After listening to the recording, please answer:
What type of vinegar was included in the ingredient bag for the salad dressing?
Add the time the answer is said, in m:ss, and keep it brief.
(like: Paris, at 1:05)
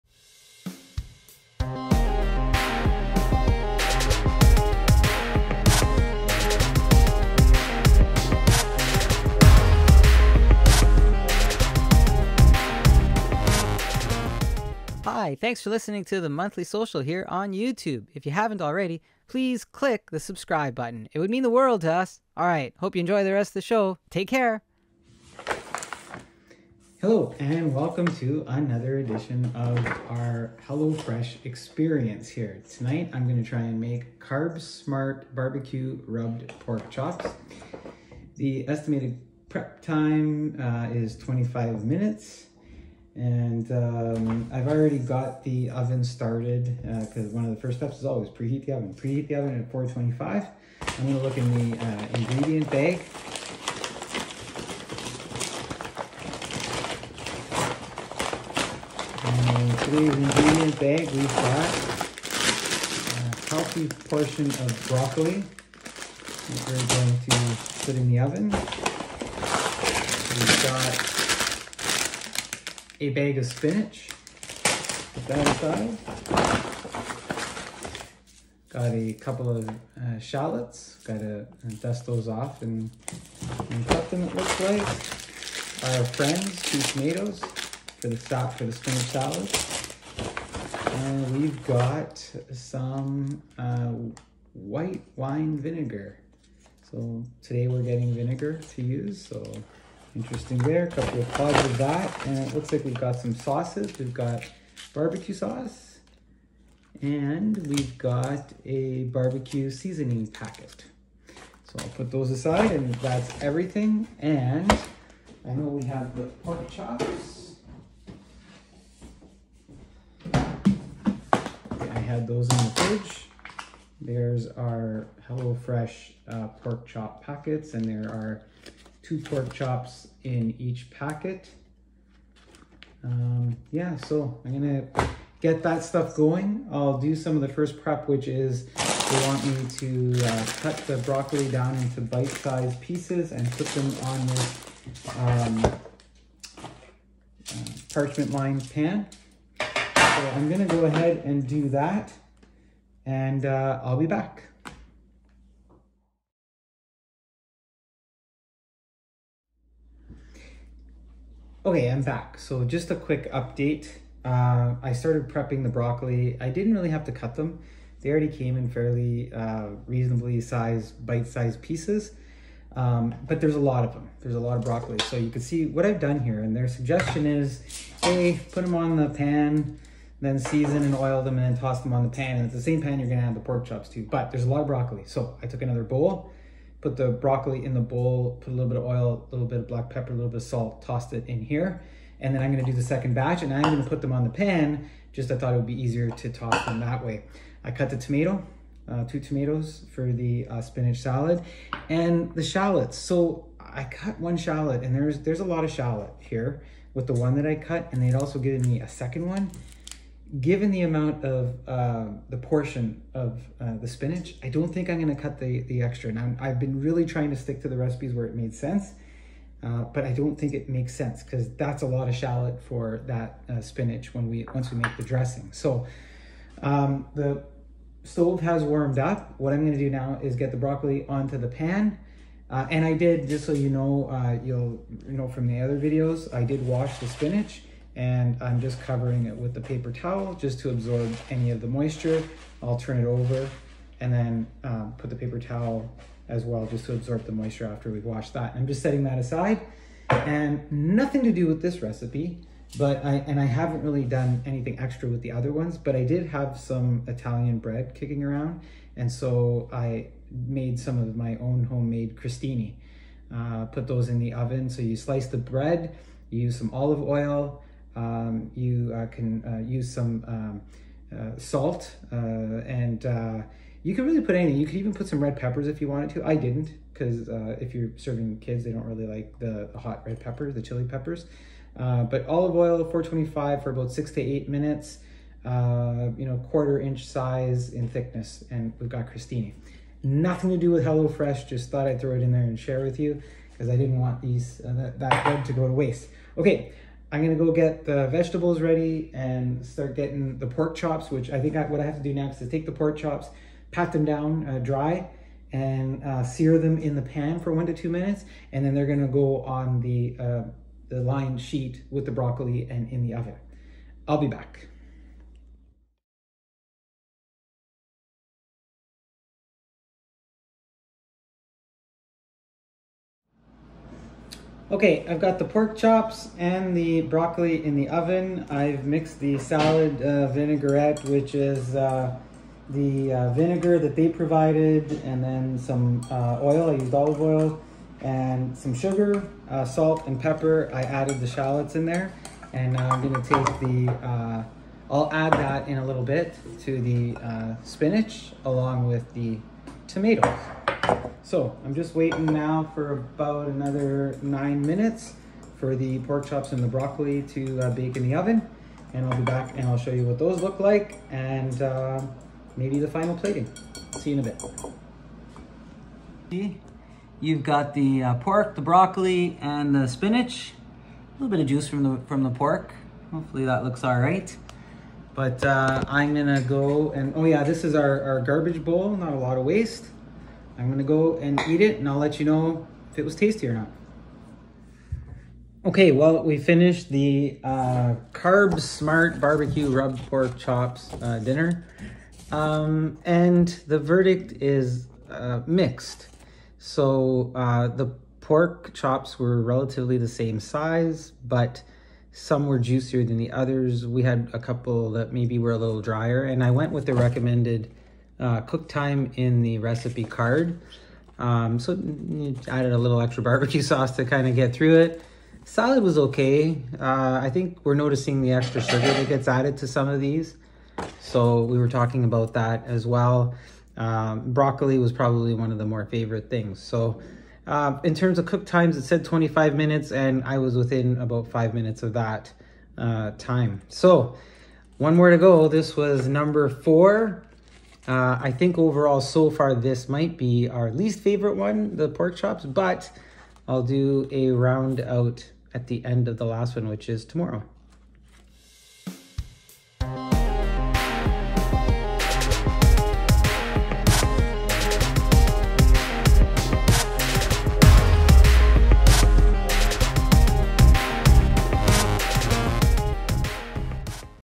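White wine vinegar, at 1:34.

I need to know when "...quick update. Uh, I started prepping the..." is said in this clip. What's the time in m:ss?
2:42.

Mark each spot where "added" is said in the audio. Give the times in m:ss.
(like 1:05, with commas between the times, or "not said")
5:40, 6:52, 6:59.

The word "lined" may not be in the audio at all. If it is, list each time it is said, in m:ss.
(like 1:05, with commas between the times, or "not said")
2:27, 5:11.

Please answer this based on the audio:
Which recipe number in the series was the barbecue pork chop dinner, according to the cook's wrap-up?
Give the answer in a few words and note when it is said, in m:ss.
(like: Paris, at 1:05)
4, at 7:15.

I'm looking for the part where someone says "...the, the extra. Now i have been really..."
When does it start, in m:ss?
3:35.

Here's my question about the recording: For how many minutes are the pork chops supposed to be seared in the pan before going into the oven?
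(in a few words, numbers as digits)
1 to 2 minutes.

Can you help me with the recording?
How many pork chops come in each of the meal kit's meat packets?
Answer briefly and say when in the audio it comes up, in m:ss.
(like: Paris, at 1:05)
2, at 2:09.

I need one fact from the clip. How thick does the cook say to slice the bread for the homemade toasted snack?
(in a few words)
Quarter inch.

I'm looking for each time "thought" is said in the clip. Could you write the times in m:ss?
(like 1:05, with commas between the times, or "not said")
3:15, 4:51.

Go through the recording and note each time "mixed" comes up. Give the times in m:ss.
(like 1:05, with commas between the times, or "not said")
5:28, 6:35.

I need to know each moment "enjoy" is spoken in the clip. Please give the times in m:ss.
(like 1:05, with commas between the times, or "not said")
0:22.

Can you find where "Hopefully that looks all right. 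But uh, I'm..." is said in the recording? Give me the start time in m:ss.
6:13.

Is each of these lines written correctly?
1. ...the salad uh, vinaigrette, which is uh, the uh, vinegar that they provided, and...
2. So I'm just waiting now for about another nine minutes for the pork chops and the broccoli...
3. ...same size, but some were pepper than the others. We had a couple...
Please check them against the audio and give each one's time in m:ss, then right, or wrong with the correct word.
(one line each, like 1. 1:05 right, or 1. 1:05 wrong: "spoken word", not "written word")
1. 5:29 right
2. 5:51 right
3. 6:40 wrong: "juicier", not "pepper".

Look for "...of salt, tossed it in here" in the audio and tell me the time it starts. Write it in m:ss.
3:10.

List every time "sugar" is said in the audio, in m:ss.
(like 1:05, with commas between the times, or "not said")
5:38, 6:58.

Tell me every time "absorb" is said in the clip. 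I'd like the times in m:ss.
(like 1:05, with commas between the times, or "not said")
4:00, 4:06.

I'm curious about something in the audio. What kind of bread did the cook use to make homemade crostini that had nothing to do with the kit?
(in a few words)
Italian bread.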